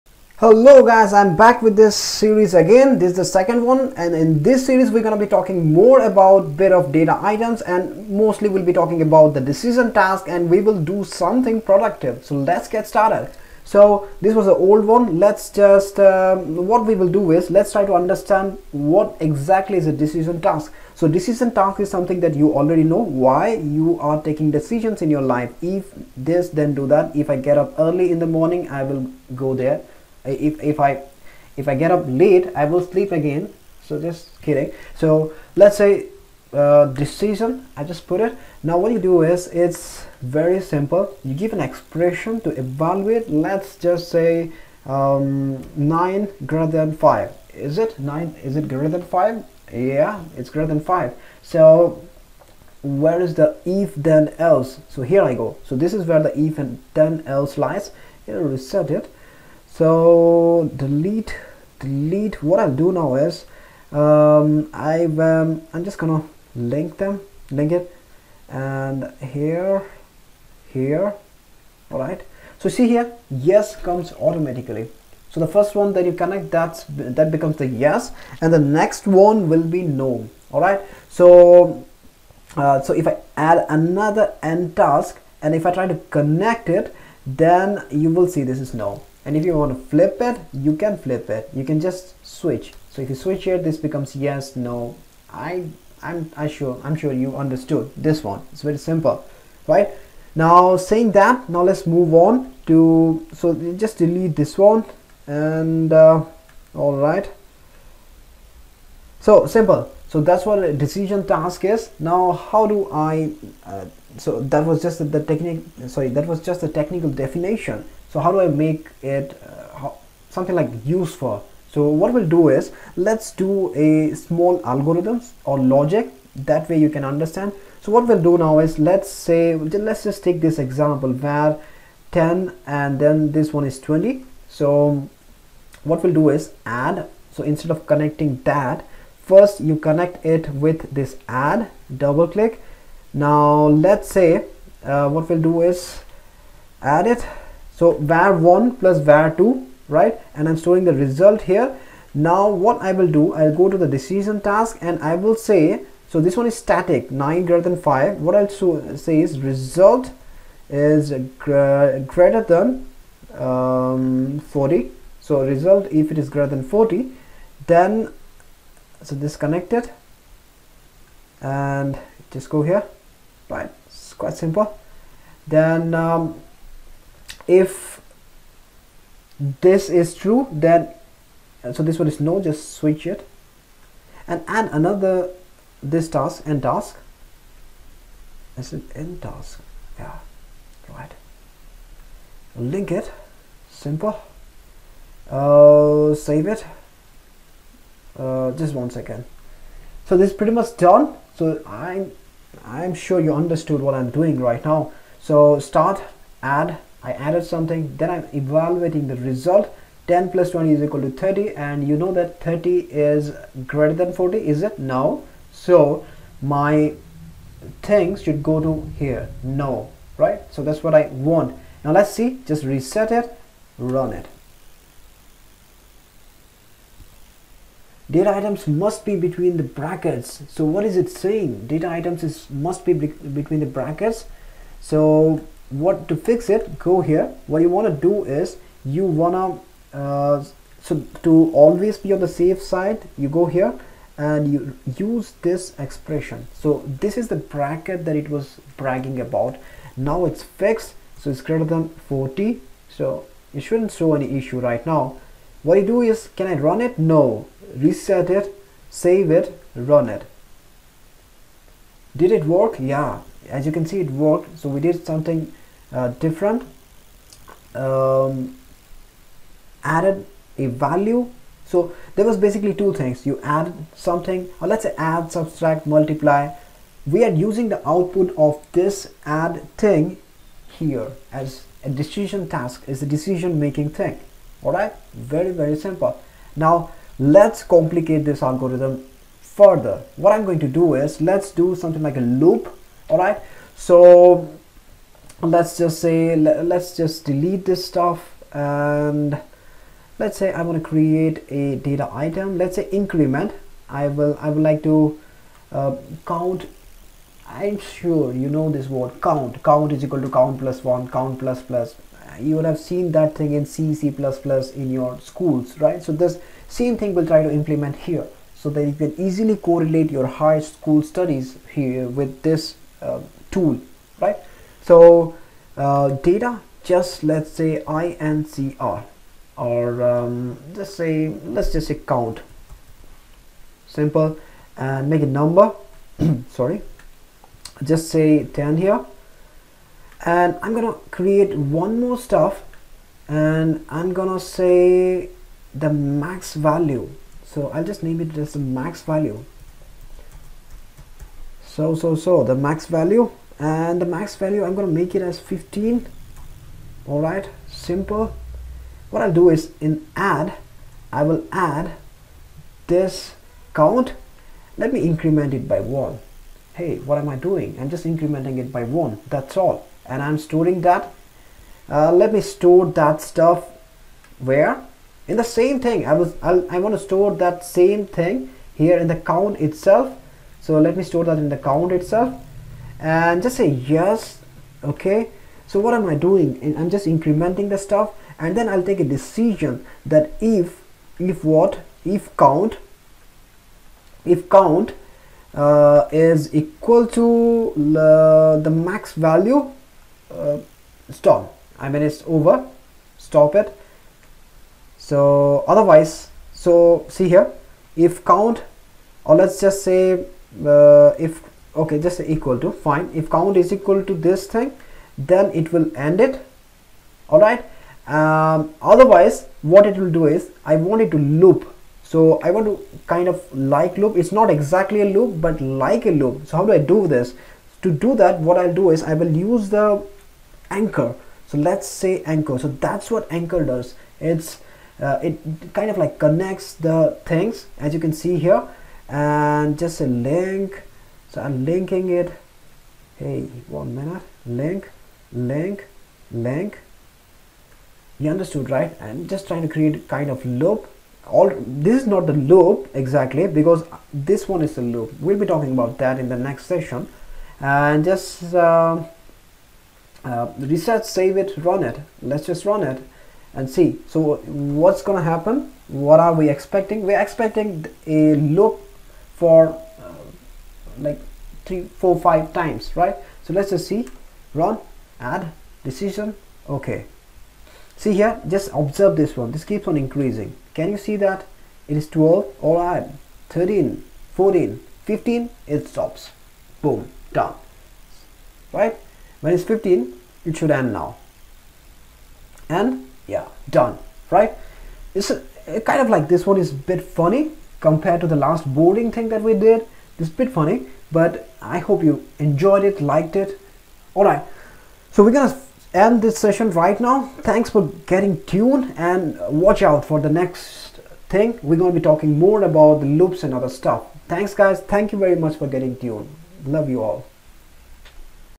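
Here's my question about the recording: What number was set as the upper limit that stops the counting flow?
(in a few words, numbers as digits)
15.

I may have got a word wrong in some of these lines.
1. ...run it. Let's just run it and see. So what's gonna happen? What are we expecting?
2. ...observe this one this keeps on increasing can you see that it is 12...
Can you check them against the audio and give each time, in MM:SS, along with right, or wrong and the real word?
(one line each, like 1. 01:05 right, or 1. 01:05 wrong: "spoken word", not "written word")
1. 07:41 right
2. 07:58 right.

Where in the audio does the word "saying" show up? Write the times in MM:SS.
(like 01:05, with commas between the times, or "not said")
01:40, 03:51.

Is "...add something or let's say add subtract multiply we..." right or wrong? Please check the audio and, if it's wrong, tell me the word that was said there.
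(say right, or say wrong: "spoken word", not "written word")
right.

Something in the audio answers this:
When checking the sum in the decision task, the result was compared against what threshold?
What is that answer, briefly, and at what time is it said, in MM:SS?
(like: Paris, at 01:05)
40, at 02:39.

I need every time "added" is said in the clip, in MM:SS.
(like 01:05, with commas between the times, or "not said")
03:27, 04:29.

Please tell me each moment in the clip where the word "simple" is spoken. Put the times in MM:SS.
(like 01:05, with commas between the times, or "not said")
00:40, 01:38, 01:49, 02:54, 03:13, 04:45, 05:33, 05:57.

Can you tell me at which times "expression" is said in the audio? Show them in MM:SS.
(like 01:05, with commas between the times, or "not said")
00:41, 04:05.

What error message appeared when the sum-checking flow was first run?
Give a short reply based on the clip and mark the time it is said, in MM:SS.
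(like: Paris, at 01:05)
Data items must be between the brackets, at 03:48.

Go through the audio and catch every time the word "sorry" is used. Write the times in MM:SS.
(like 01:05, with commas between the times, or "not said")
01:55, 05:36.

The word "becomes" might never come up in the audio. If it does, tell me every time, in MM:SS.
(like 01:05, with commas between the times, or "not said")
01:17, 01:33.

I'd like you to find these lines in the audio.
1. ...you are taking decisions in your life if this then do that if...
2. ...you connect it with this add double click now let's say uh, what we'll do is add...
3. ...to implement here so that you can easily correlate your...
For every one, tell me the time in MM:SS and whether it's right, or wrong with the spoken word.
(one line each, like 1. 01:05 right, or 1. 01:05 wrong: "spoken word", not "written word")
1. 00:23 right
2. 02:19 right
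3. 05:17 right.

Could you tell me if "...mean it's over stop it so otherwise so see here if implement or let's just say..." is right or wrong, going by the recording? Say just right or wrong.
wrong.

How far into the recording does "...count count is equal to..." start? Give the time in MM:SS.
05:09.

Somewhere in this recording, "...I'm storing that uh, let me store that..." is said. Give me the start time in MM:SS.
06:10.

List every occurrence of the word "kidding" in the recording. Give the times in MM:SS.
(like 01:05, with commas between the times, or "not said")
00:34.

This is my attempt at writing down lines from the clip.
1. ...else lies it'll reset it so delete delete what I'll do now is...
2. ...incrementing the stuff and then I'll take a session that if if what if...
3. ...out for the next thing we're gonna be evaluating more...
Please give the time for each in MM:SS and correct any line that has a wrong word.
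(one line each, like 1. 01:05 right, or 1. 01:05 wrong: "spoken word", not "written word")
1. 00:57 right
2. 06:27 wrong: "decision", not "session"
3. 08:29 wrong: "talking", not "evaluating".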